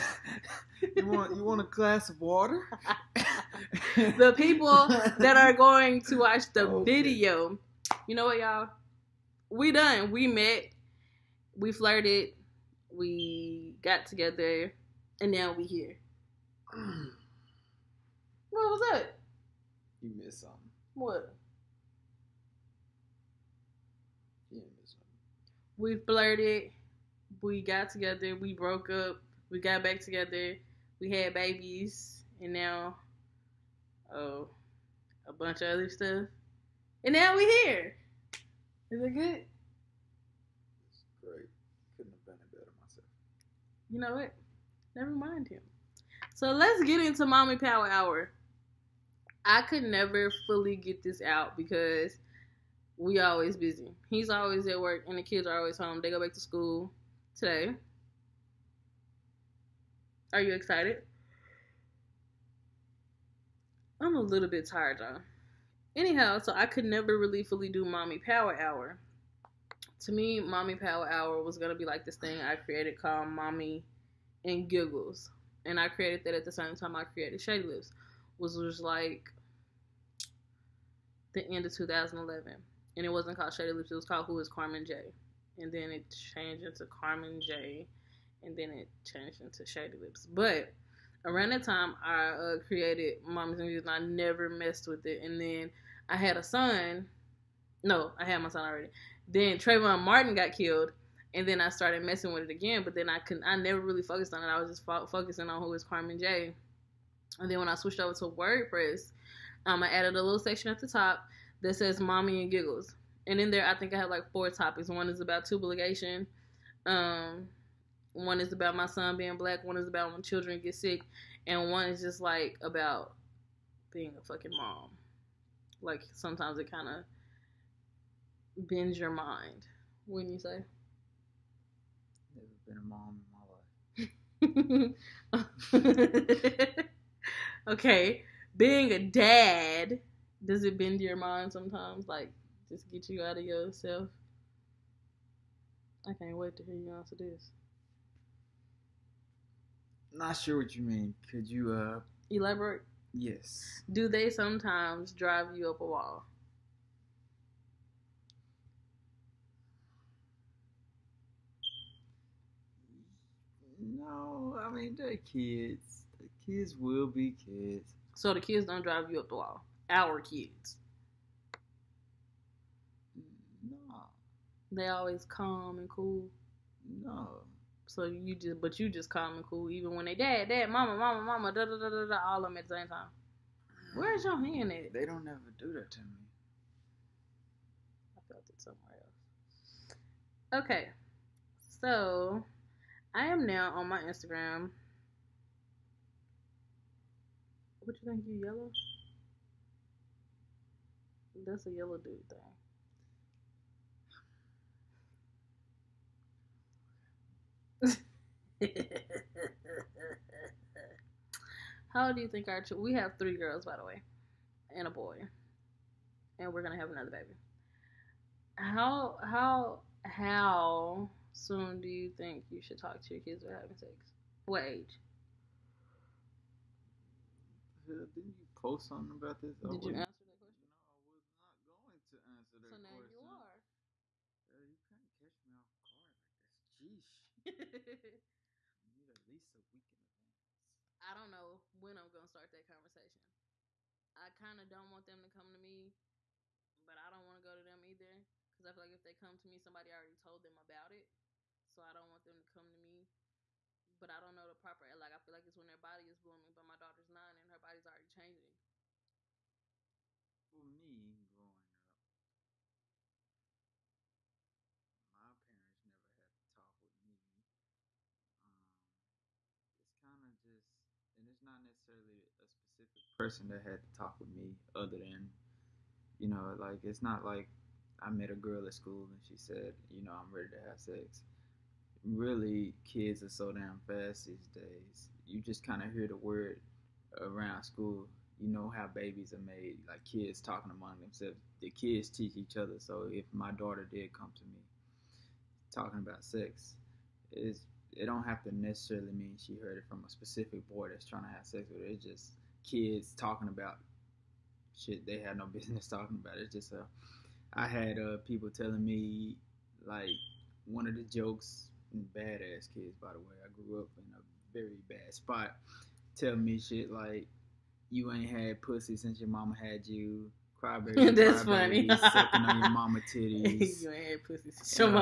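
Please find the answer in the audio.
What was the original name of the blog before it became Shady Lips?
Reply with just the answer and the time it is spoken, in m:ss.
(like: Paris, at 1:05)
Who is Carmen J, at 1:24.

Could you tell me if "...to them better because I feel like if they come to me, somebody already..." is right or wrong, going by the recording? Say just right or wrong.
wrong.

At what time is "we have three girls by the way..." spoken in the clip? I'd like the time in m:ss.
3:32.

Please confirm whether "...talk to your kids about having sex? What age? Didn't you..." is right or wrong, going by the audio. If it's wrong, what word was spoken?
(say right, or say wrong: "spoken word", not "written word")
right.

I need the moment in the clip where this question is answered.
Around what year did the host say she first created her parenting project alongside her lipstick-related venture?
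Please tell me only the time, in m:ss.
1:21.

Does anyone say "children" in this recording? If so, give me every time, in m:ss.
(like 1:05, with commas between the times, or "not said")
2:00.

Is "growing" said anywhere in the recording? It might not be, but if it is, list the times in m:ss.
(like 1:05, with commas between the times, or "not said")
4:21.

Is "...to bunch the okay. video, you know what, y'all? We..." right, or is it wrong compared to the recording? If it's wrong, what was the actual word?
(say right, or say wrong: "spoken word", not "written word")
wrong: "watch", not "bunch".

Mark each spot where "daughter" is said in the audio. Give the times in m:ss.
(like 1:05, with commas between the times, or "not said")
4:16, 4:53.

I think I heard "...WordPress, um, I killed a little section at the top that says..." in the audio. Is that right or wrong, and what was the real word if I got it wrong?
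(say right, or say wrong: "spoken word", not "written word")
wrong: "added", not "killed".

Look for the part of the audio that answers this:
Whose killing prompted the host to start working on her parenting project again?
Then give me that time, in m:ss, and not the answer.
1:39.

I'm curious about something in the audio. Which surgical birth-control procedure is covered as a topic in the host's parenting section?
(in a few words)
Tubal ligation.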